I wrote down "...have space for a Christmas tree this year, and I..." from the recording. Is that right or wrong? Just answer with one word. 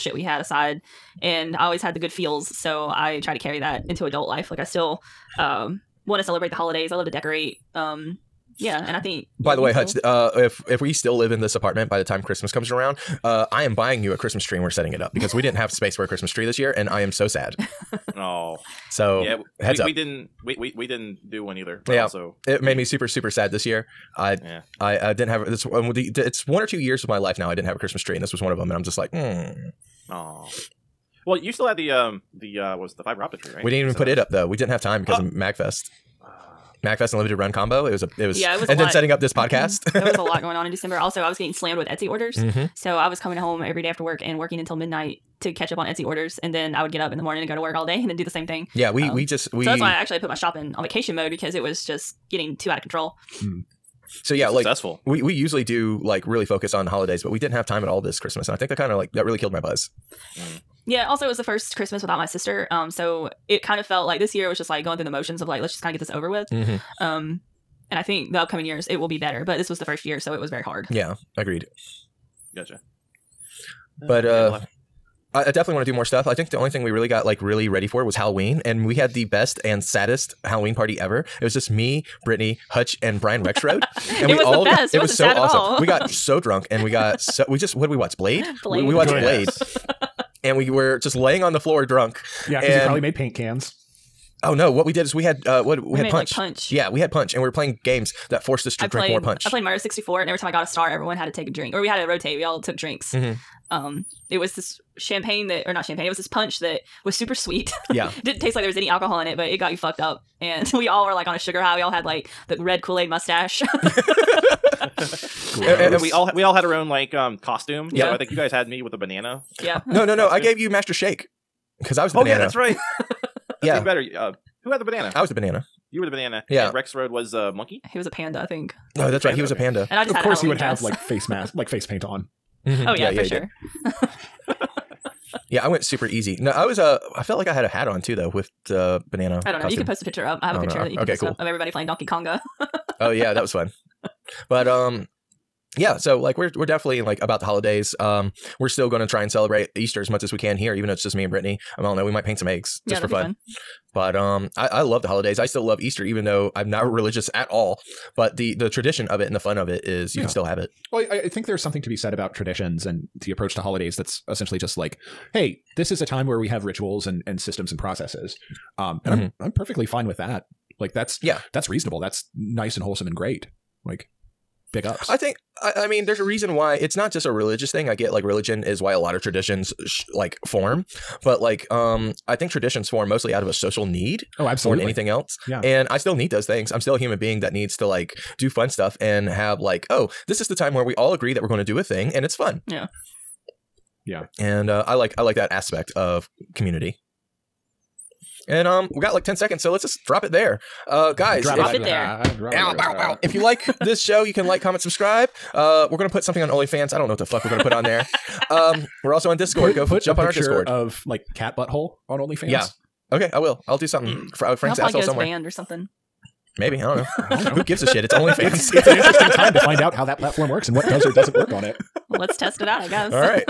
right.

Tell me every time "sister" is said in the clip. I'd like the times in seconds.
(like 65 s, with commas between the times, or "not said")
62 s.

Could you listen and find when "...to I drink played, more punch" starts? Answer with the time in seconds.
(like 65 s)
98 s.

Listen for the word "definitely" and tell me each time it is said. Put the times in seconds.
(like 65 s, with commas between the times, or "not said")
75 s, 146 s.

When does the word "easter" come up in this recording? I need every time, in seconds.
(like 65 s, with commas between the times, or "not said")
149 s, 155 s.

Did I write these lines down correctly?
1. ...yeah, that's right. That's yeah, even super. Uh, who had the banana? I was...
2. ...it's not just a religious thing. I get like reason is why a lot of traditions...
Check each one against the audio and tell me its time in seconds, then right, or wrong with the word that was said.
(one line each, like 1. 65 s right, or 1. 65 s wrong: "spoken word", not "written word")
1. 122 s wrong: "better", not "super"
2. 176 s wrong: "religion", not "reason".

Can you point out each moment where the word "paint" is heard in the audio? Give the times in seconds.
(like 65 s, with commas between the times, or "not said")
93 s, 131 s, 152 s.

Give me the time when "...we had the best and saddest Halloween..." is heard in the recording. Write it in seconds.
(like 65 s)
78 s.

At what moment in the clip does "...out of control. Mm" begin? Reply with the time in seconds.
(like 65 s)
52 s.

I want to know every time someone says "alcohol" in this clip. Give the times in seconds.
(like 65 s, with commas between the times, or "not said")
108 s.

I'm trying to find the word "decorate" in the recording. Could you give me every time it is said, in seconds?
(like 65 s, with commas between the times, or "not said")
7 s.